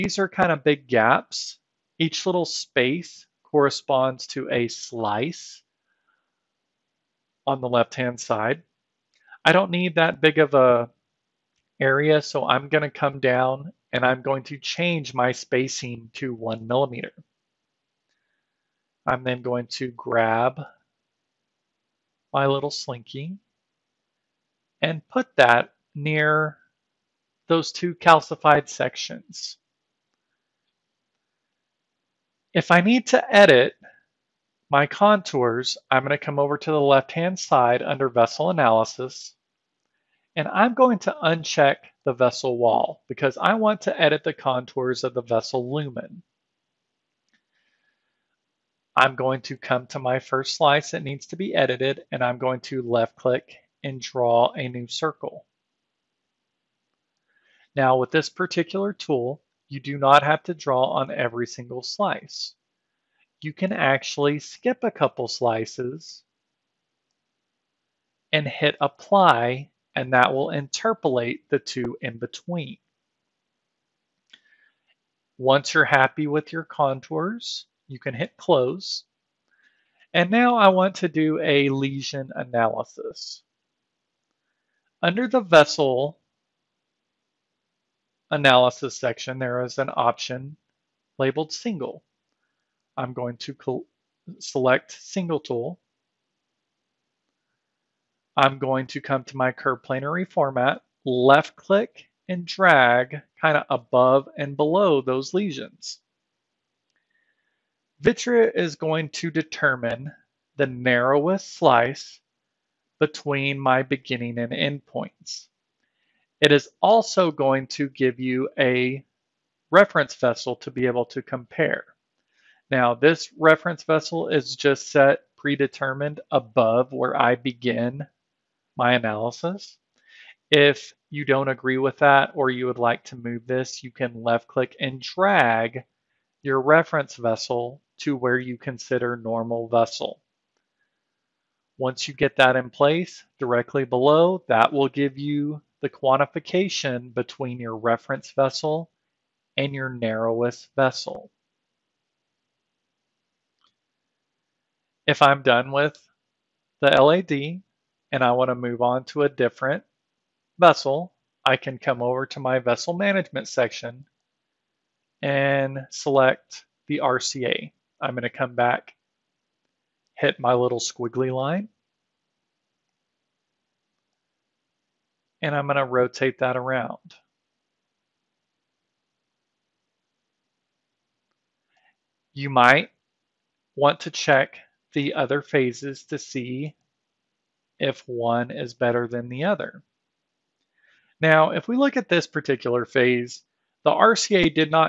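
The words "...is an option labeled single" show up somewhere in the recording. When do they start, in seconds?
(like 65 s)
89 s.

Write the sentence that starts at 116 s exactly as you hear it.
It is also going to give you a reference vessel to be able to compare.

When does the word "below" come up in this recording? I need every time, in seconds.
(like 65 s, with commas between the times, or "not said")
104 s, 143 s.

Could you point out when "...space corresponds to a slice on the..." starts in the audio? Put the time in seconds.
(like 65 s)
2 s.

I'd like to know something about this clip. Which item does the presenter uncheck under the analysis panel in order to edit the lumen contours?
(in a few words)
vessel wall.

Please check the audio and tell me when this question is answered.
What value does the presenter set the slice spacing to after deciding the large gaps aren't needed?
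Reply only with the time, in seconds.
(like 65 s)
16 s.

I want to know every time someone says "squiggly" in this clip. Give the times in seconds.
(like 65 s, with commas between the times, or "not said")
170 s.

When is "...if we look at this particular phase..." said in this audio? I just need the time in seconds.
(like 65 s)
191 s.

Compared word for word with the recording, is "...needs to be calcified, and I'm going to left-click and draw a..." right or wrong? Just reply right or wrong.
wrong.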